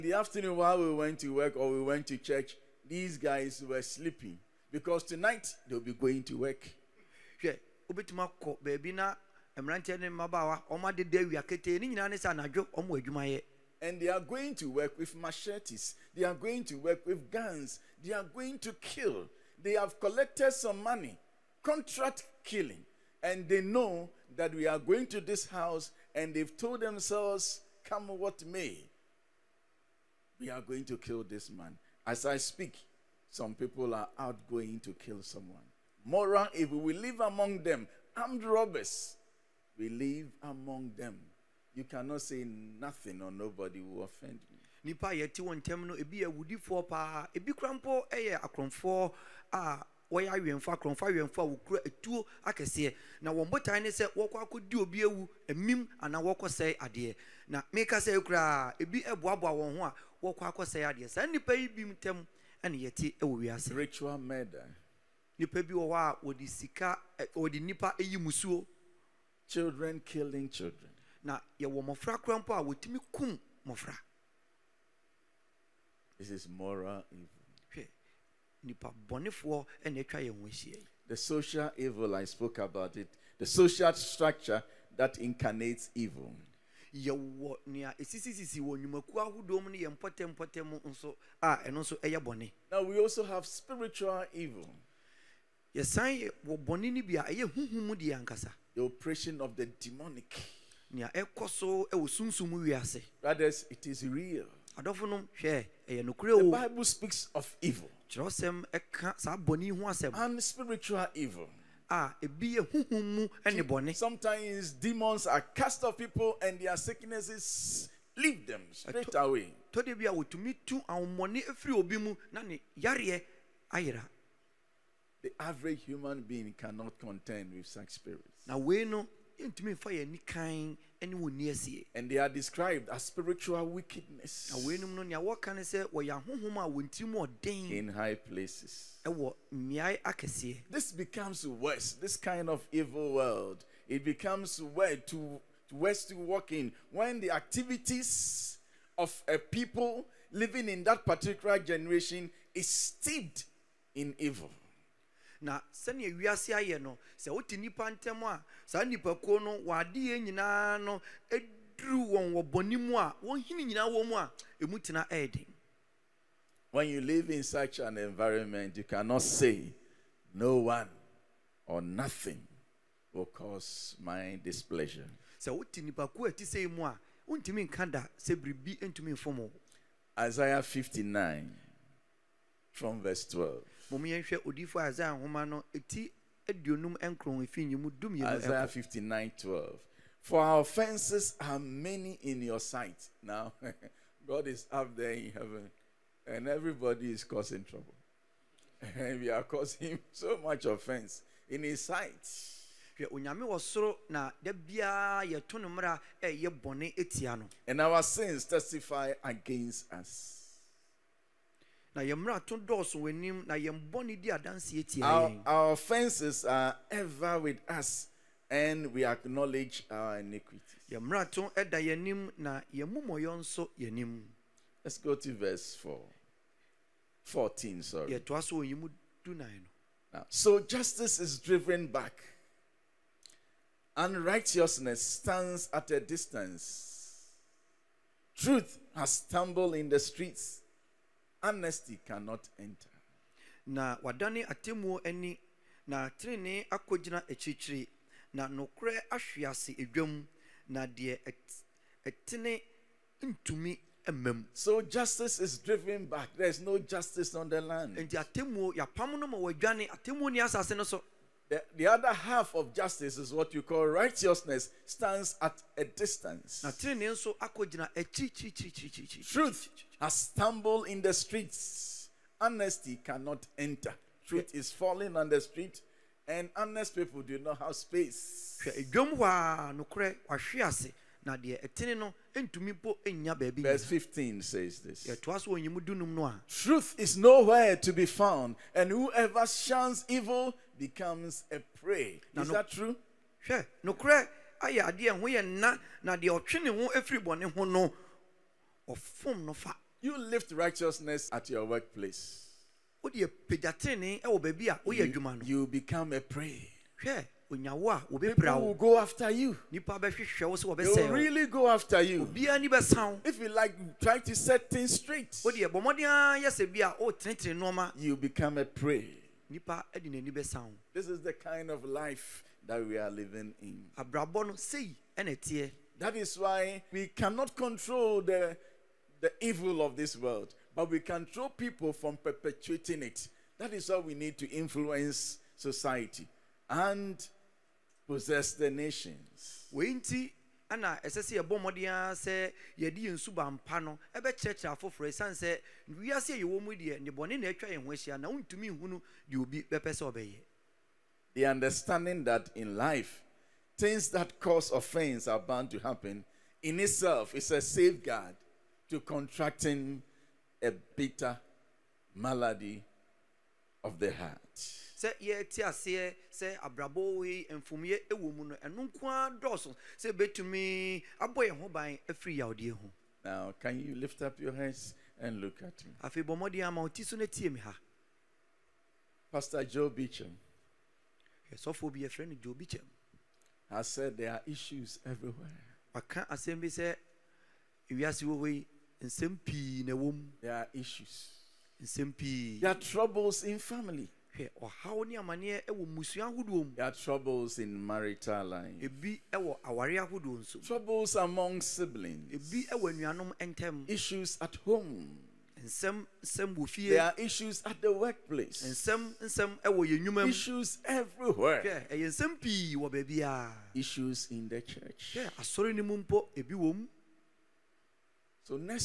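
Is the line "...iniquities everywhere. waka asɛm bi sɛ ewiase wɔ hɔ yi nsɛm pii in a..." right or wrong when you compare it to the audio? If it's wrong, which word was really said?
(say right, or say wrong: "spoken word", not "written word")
wrong: "issues", not "iniquities".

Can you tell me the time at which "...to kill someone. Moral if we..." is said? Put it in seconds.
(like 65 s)
34 s.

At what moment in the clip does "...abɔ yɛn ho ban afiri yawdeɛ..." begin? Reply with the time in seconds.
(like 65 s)
371 s.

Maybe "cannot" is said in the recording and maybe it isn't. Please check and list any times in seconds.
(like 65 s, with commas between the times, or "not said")
41 s, 126 s, 168 s, 242 s, 273 s, 327 s.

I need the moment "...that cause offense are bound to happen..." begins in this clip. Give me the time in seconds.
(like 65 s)
354 s.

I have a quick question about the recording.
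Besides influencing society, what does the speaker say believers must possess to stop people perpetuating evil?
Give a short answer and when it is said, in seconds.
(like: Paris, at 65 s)
the nations, at 338 s.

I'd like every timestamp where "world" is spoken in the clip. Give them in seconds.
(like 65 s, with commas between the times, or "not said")
143 s, 330 s.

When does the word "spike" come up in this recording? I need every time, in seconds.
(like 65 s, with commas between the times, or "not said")
not said.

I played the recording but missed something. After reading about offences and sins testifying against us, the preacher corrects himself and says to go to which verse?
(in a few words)
14.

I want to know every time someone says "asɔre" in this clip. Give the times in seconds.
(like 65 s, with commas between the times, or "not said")
415 s.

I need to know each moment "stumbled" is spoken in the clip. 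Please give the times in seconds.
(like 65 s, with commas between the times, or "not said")
239 s, 270 s.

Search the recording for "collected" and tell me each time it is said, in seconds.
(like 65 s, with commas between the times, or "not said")
20 s.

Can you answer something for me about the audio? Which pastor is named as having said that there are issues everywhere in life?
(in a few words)
Joe Beecham.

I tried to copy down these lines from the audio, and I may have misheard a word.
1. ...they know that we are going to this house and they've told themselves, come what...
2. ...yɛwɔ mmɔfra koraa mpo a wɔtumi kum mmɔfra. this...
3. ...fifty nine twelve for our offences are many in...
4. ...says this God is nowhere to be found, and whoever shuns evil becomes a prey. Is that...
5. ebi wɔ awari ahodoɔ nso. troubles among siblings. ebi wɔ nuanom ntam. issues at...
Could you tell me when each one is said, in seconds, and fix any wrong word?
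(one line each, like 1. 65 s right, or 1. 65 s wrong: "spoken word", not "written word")
1. 23 s right
2. 71 s right
3. 188 s right
4. 284 s wrong: "Truth", not "God"
5. 398 s right.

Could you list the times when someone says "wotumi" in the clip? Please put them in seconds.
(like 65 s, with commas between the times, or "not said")
120 s.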